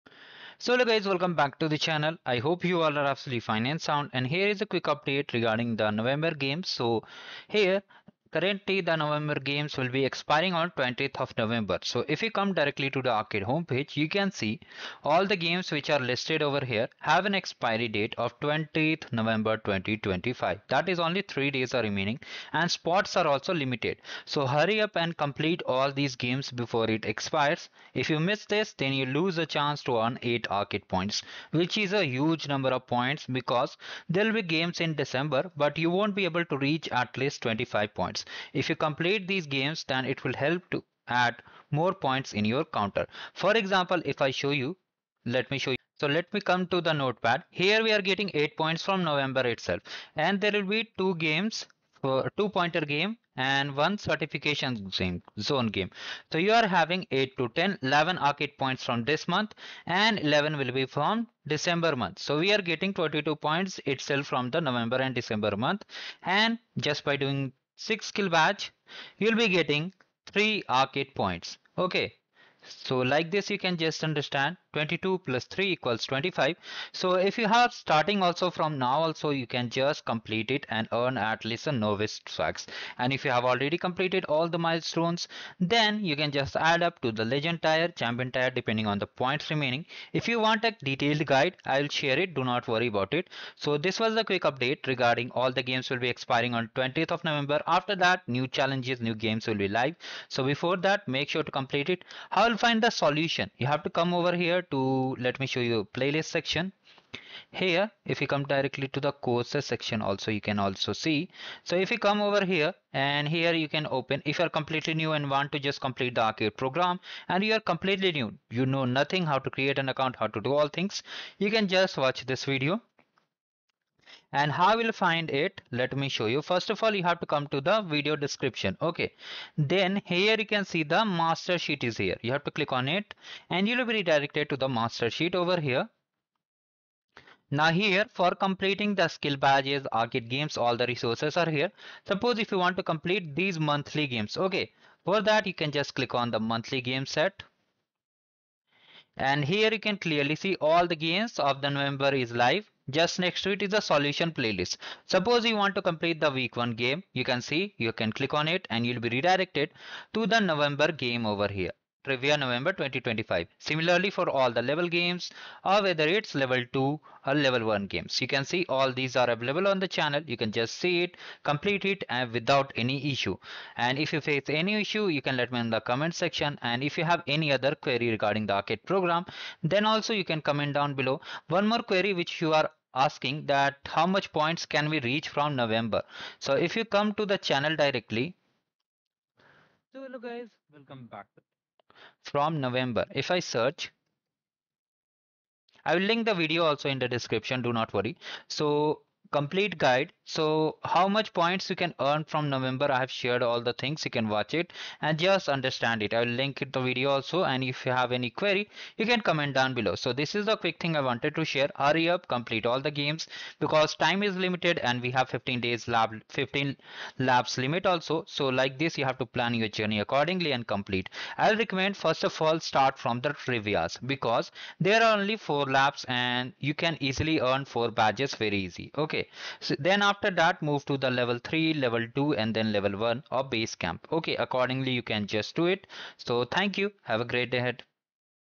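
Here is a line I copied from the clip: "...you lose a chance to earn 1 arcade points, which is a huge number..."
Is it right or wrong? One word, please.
wrong.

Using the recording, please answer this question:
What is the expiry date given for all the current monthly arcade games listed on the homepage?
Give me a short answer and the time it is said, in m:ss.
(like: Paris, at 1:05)
20th November 2025, at 0:18.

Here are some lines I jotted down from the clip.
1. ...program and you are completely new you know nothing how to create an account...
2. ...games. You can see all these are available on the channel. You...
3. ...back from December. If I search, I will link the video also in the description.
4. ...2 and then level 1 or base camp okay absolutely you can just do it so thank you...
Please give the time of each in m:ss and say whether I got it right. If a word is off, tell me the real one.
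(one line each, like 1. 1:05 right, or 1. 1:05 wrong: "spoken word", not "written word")
1. 1:56 right
2. 2:47 right
3. 3:11 wrong: "November", not "December"
4. 3:52 wrong: "accordingly", not "absolutely".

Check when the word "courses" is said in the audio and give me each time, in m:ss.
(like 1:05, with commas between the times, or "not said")
1:49.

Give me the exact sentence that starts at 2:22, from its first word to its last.
Suppose if you want to complete these monthly games, okay.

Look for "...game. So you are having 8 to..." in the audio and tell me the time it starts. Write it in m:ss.
0:55.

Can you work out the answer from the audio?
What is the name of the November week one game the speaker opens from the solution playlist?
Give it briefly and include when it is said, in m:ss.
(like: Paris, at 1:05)
Trivia November 2025, at 2:42.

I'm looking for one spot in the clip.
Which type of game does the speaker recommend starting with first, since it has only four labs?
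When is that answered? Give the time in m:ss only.
3:43.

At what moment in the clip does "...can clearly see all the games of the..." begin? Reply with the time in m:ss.
2:29.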